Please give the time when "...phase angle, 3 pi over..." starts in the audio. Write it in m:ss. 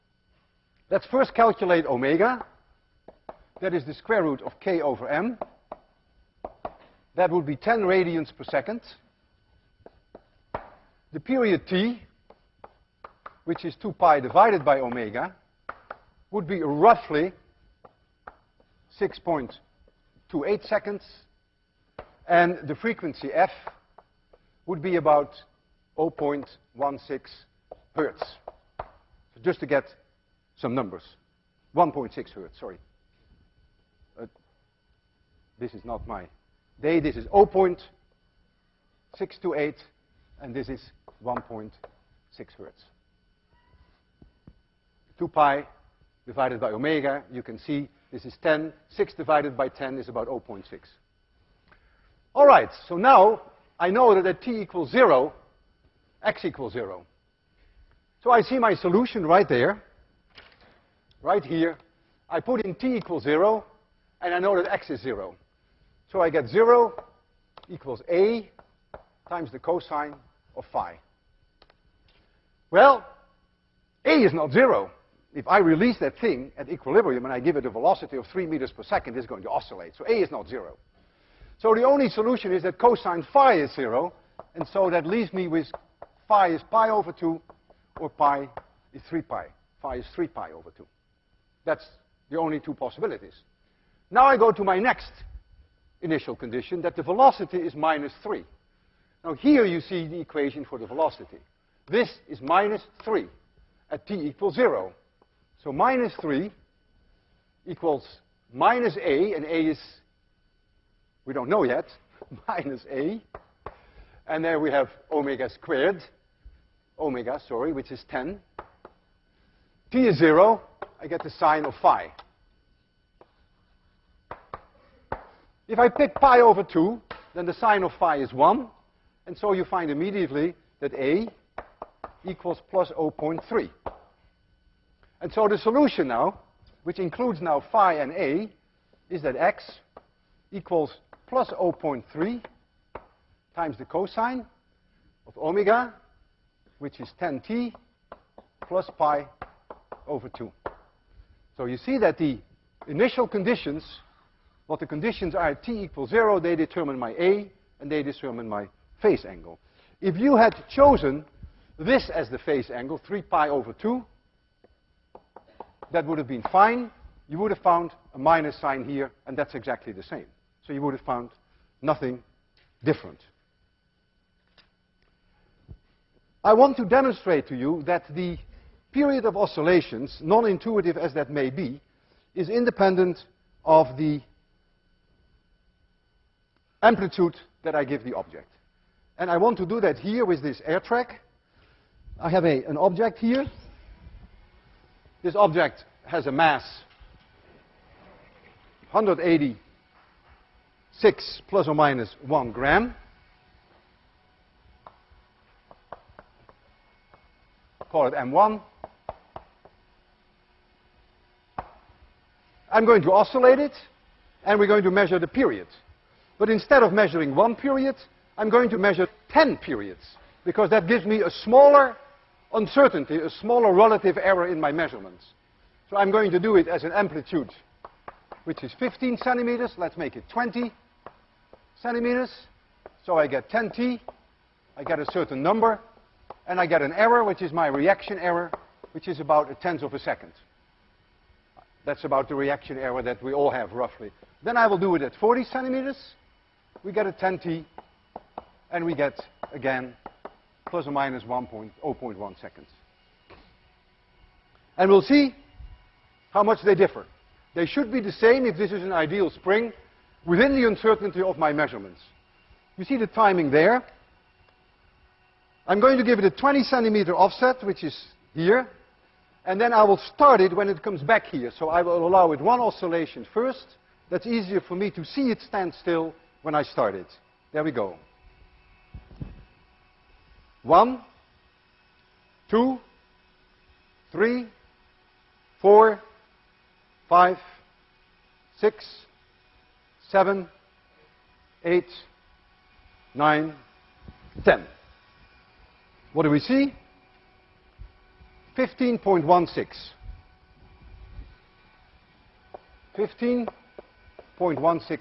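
2:42.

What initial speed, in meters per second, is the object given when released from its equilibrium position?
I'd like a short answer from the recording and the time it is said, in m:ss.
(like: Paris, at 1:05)
3 meters per second, at 1:18.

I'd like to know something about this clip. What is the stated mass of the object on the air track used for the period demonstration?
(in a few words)
186 grams.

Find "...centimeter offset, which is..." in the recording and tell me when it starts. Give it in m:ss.
4:26.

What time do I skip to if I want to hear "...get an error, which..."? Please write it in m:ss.
3:56.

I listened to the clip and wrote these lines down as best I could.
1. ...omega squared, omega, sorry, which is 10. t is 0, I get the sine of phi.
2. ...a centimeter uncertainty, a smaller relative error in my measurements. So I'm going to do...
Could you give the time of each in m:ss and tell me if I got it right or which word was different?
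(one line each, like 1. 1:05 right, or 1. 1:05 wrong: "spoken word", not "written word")
1. 1:55 right
2. 3:41 wrong: "smaller", not "centimeter".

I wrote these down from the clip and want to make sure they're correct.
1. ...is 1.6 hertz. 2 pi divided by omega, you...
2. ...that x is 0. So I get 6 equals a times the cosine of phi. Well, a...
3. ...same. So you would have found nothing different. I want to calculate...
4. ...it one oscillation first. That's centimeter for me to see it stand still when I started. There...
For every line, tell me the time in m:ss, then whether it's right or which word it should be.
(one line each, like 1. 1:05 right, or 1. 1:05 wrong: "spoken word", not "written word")
1. 0:40 right
2. 1:04 wrong: "0", not "6"
3. 2:50 wrong: "demonstrate", not "calculate"
4. 4:32 wrong: "easier", not "centimeter".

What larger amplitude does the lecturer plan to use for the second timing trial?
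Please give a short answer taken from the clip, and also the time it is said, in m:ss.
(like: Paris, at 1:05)
40 centimeters, at 4:05.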